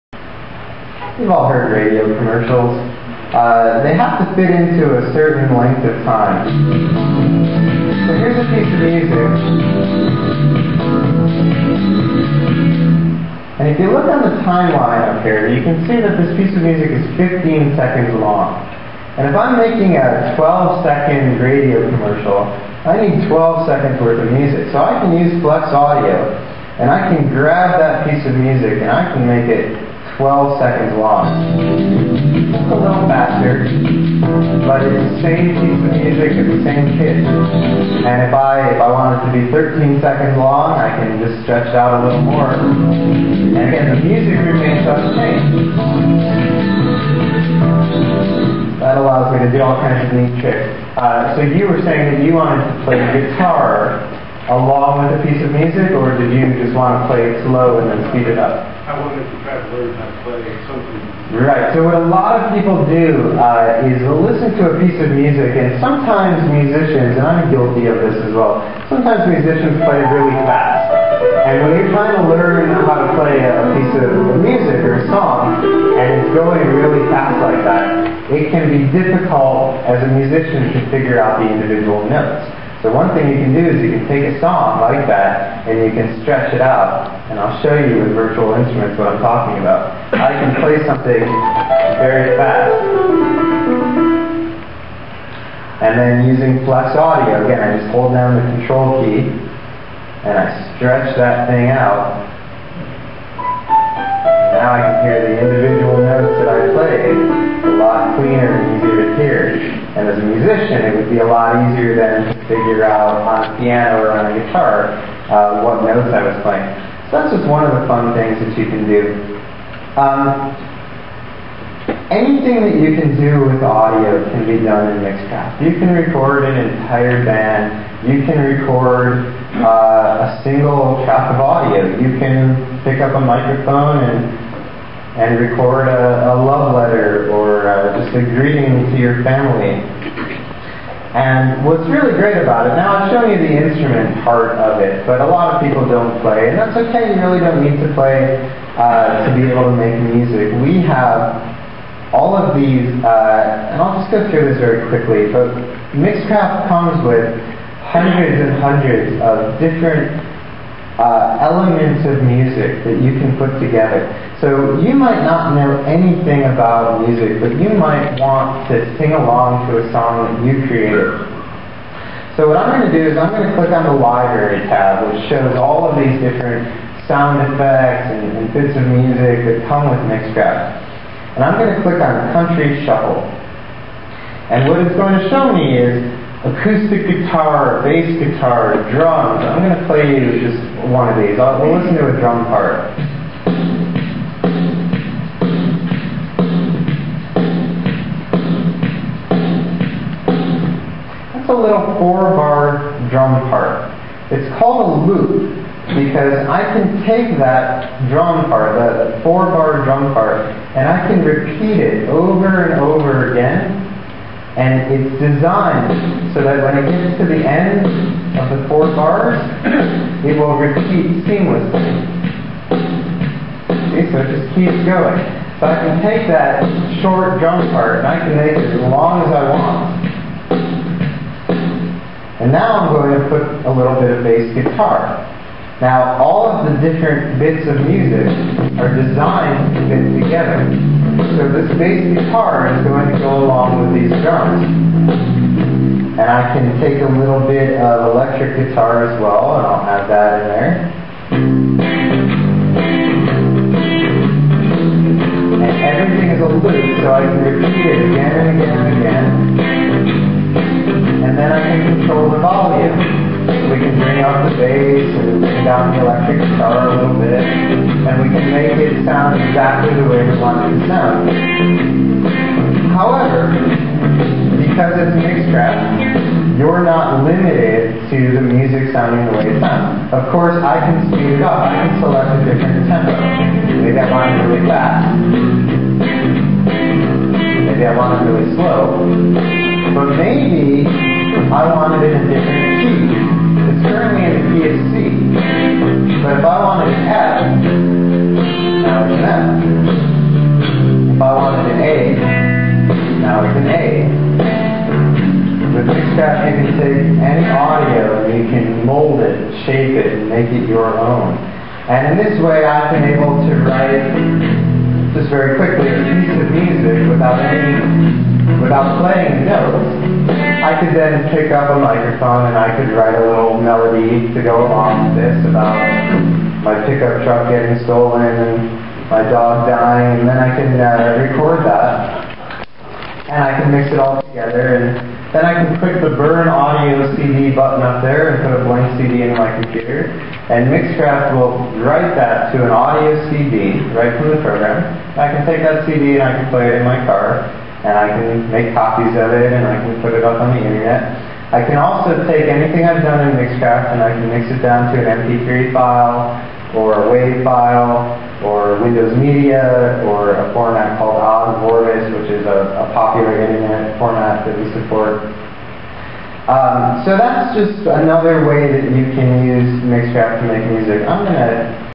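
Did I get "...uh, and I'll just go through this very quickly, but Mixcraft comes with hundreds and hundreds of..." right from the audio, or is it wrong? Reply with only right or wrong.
right.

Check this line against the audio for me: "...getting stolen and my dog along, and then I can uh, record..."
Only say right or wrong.
wrong.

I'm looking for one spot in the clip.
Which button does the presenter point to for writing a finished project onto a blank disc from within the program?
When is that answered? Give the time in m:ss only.
5:36.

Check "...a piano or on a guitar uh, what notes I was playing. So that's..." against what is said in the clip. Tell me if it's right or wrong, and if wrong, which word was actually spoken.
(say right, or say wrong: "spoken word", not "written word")
right.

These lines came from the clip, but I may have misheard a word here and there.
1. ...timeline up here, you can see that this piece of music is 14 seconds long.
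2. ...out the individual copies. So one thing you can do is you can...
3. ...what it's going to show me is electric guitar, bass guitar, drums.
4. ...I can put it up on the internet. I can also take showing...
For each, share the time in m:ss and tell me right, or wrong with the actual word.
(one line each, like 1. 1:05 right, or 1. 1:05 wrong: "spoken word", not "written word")
1. 0:14 wrong: "15", not "14"
2. 1:21 wrong: "notes", not "copies"
3. 3:04 wrong: "acoustic", not "electric"
4. 5:49 wrong: "anything", not "showing".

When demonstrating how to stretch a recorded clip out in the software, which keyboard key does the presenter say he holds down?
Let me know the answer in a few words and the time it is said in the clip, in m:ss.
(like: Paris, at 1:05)
Control key, at 1:38.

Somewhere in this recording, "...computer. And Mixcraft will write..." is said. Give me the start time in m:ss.
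5:39.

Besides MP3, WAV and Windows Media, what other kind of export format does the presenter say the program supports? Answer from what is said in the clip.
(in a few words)
Popular internet format.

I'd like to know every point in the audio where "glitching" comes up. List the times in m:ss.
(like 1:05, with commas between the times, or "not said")
not said.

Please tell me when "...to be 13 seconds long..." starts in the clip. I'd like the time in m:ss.
0:39.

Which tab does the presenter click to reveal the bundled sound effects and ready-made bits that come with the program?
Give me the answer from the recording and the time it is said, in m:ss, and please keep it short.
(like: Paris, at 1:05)
Library tab, at 2:53.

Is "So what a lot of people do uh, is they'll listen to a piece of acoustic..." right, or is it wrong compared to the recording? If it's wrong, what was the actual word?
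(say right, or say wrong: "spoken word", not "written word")
wrong: "music", not "acoustic".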